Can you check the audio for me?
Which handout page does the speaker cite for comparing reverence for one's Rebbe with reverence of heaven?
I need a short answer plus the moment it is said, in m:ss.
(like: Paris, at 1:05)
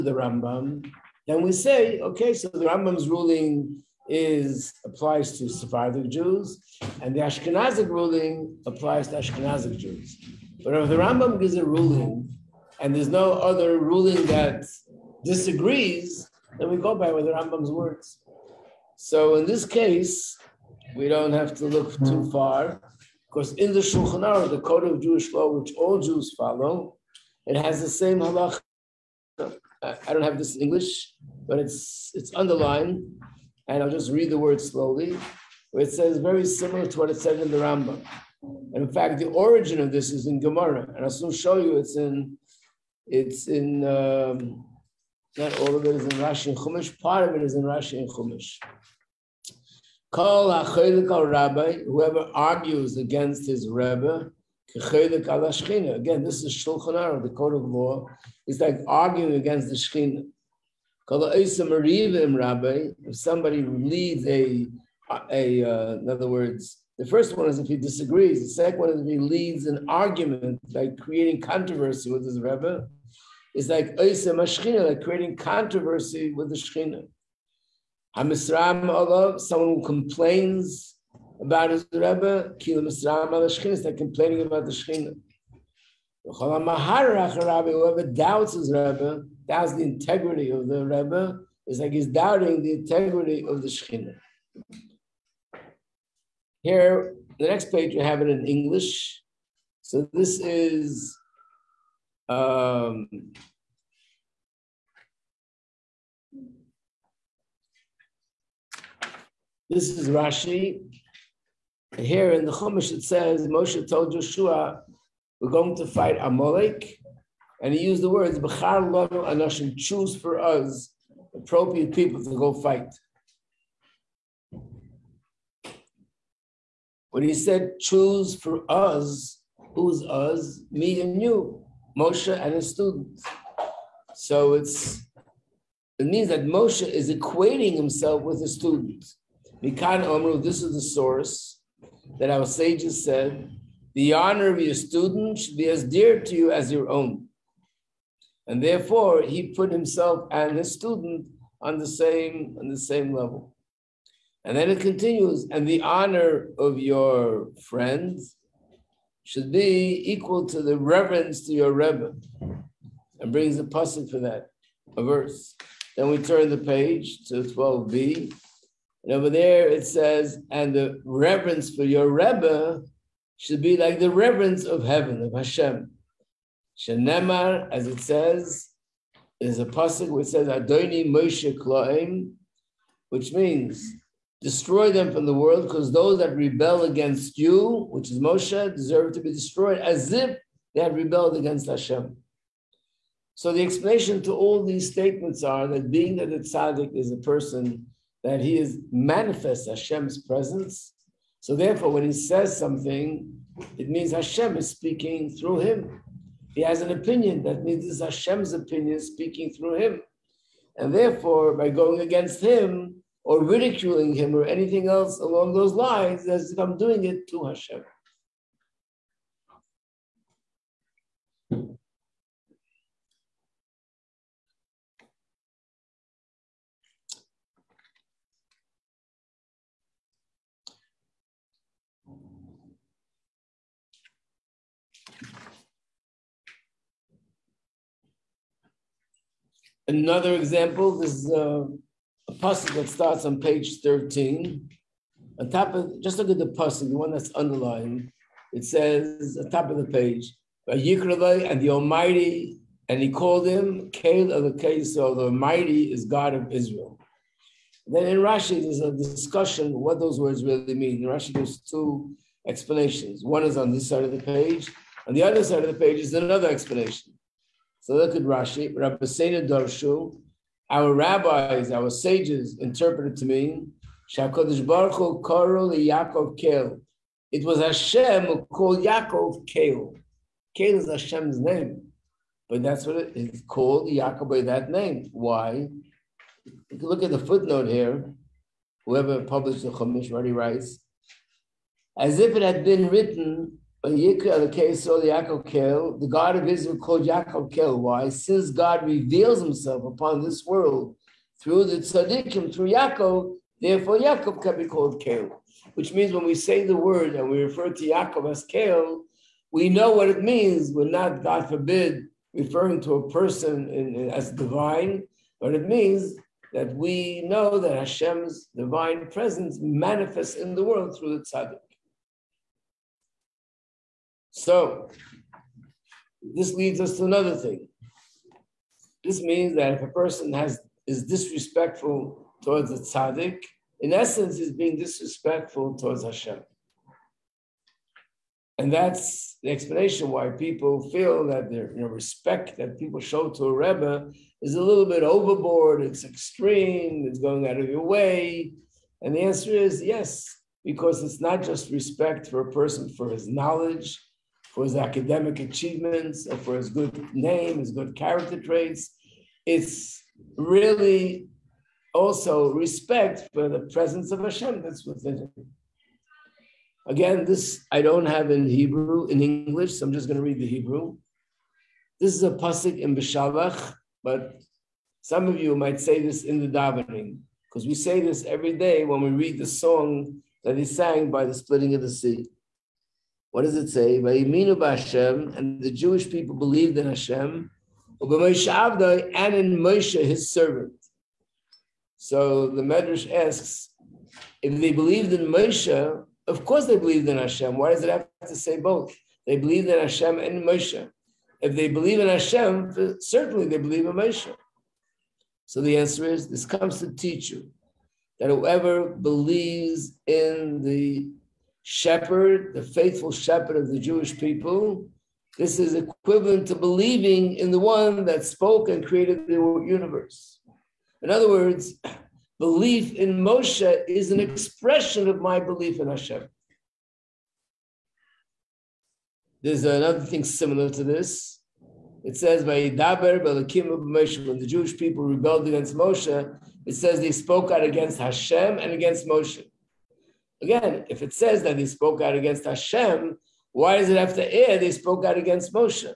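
12b, at 2:47.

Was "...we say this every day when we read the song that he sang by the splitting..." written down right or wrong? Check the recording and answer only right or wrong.
right.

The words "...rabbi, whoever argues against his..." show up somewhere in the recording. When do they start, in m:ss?
0:51.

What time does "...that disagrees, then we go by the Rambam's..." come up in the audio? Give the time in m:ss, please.
0:14.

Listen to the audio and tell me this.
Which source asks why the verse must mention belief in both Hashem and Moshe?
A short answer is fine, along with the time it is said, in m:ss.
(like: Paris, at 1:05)
Medrash, at 6:32.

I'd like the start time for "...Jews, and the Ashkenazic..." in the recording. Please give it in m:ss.
0:06.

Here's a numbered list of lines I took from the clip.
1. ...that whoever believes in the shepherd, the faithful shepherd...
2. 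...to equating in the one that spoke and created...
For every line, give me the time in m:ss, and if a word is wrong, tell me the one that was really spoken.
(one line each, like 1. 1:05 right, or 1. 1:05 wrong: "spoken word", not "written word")
1. 6:48 right
2. 6:56 wrong: "believing", not "equating".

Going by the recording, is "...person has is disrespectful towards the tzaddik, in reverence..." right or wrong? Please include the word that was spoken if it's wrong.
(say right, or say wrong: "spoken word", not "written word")
wrong: "essence", not "reverence".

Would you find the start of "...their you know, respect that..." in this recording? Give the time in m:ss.
5:41.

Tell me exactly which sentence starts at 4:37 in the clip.
It was Hashem who called Yaakov Kale.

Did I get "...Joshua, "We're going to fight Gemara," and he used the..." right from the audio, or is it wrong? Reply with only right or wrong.
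wrong.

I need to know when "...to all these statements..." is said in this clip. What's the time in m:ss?
3:14.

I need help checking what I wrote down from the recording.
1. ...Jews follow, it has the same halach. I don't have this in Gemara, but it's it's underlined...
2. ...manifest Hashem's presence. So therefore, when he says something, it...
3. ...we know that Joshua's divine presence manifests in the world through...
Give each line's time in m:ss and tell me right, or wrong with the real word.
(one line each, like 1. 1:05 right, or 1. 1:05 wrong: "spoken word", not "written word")
1. 0:25 wrong: "English", not "Gemara"
2. 3:18 right
3. 5:16 wrong: "Hashem", not "Joshua".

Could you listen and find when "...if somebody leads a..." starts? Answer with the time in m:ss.
1:03.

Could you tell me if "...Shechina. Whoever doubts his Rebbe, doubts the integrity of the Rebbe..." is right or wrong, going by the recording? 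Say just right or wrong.
right.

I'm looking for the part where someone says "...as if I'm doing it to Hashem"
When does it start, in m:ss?
3:36.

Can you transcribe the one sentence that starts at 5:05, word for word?
Which means when we say the word and we refer to Yaakov as Kel, we know what it means.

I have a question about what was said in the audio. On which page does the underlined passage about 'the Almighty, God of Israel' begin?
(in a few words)
13.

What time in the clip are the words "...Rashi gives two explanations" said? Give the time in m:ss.
4:21.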